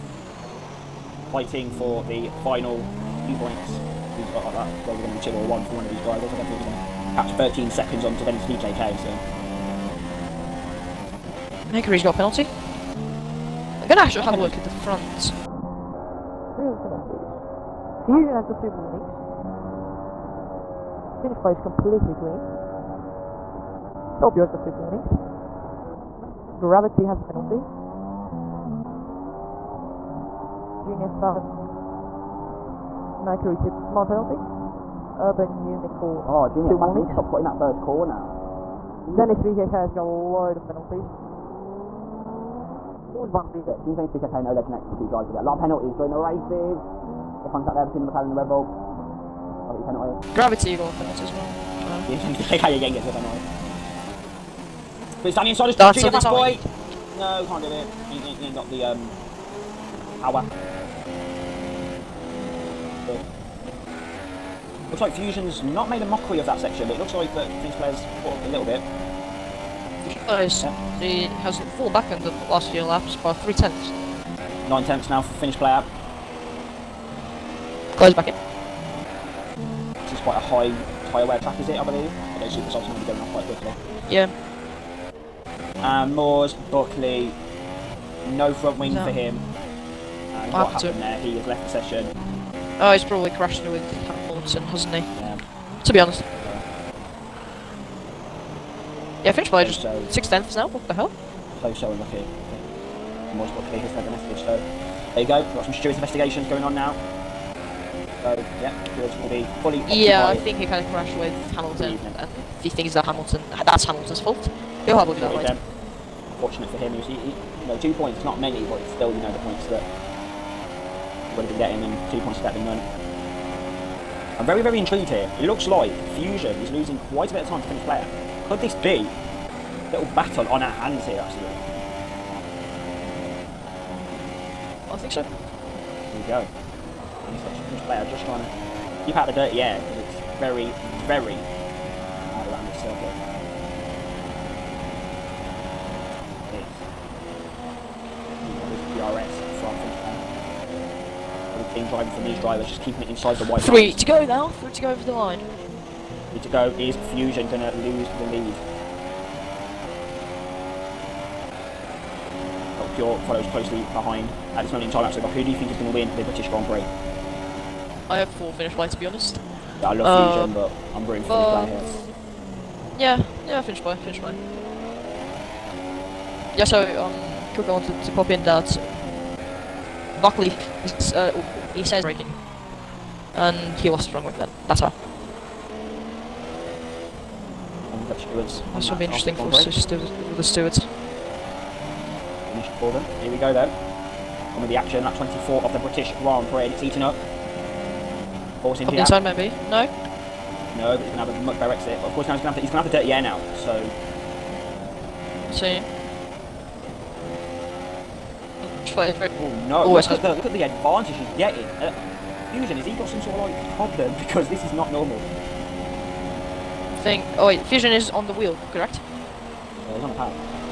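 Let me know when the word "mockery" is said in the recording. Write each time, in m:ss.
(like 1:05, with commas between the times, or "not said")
1:06.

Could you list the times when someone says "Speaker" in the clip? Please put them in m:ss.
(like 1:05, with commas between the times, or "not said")
0:44.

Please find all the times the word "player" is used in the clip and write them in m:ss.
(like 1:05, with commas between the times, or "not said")
1:07, 1:15, 2:07, 2:17.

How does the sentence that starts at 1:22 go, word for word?
Although super softs may be going off quite quickly.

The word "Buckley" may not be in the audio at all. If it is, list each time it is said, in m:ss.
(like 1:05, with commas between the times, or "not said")
1:26, 1:43, 3:00.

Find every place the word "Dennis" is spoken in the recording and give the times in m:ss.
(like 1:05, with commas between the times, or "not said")
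0:39.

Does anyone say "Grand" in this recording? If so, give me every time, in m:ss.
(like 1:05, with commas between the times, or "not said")
2:46, 3:16.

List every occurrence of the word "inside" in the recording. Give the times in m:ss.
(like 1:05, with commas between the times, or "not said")
0:55, 2:33, 3:19.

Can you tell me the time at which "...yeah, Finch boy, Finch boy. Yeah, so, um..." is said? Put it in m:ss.
2:53.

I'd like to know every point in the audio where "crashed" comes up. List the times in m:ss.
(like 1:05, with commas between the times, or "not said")
1:33, 1:50.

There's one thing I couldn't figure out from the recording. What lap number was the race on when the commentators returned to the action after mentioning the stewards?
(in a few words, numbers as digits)
24.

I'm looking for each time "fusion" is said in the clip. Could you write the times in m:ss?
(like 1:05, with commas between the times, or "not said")
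0:18, 1:05, 2:06, 2:37, 2:50, 3:32, 3:37.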